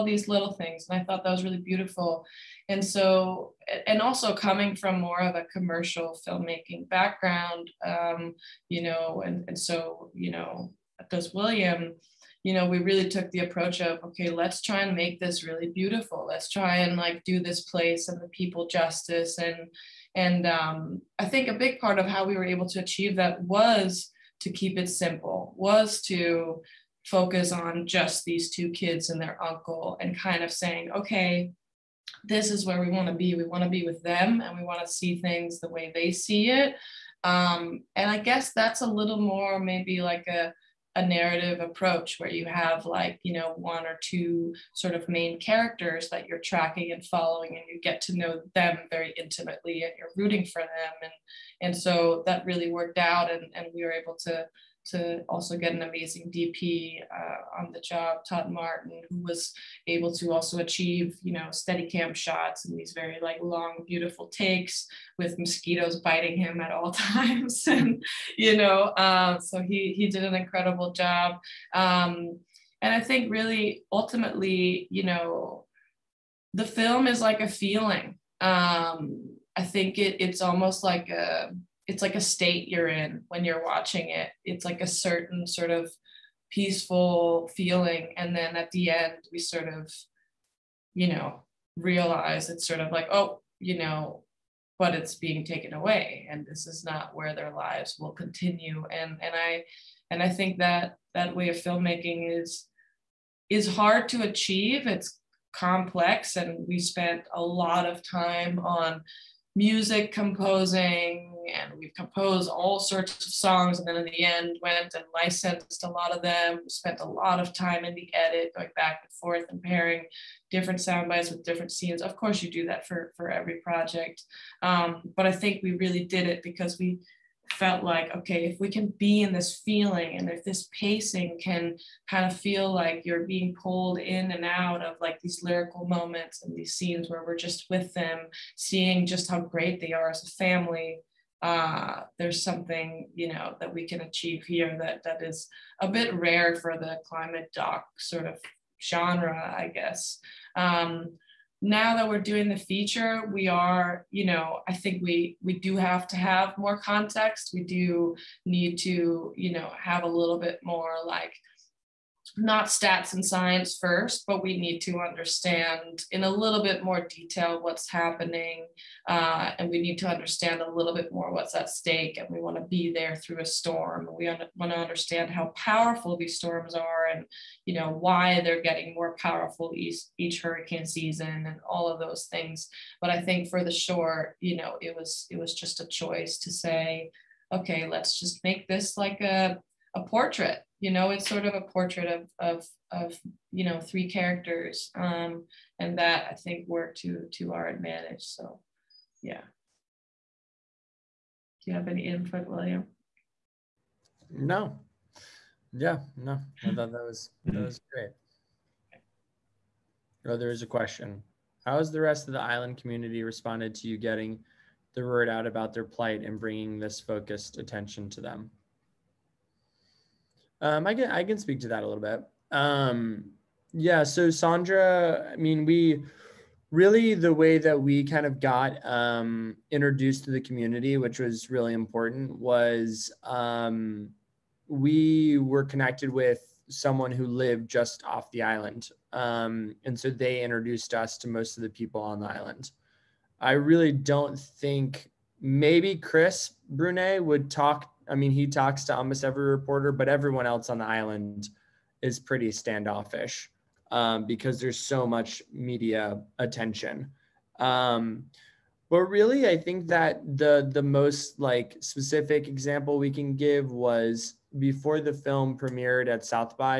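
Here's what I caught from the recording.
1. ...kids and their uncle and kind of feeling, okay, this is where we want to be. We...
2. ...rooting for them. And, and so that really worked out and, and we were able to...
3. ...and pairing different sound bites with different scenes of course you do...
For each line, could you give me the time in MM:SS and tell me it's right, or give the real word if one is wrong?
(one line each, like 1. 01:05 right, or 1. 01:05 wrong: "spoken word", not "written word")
1. 00:28 wrong: "saying", not "feeling"
2. 00:50 right
3. 01:59 right.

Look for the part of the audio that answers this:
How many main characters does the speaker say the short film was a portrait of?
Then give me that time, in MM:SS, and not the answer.
03:13.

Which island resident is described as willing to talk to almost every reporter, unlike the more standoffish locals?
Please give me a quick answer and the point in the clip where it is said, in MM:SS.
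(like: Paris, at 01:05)
Chris Brunet, at 04:05.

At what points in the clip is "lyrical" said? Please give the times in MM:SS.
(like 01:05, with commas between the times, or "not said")
02:15.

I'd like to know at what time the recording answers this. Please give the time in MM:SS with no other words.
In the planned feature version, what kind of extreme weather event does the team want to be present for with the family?
02:53.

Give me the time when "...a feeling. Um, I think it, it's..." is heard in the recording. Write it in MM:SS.
01:17.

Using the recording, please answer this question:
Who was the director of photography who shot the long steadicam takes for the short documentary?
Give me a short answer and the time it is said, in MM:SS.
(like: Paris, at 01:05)
Todd Martin, at 00:58.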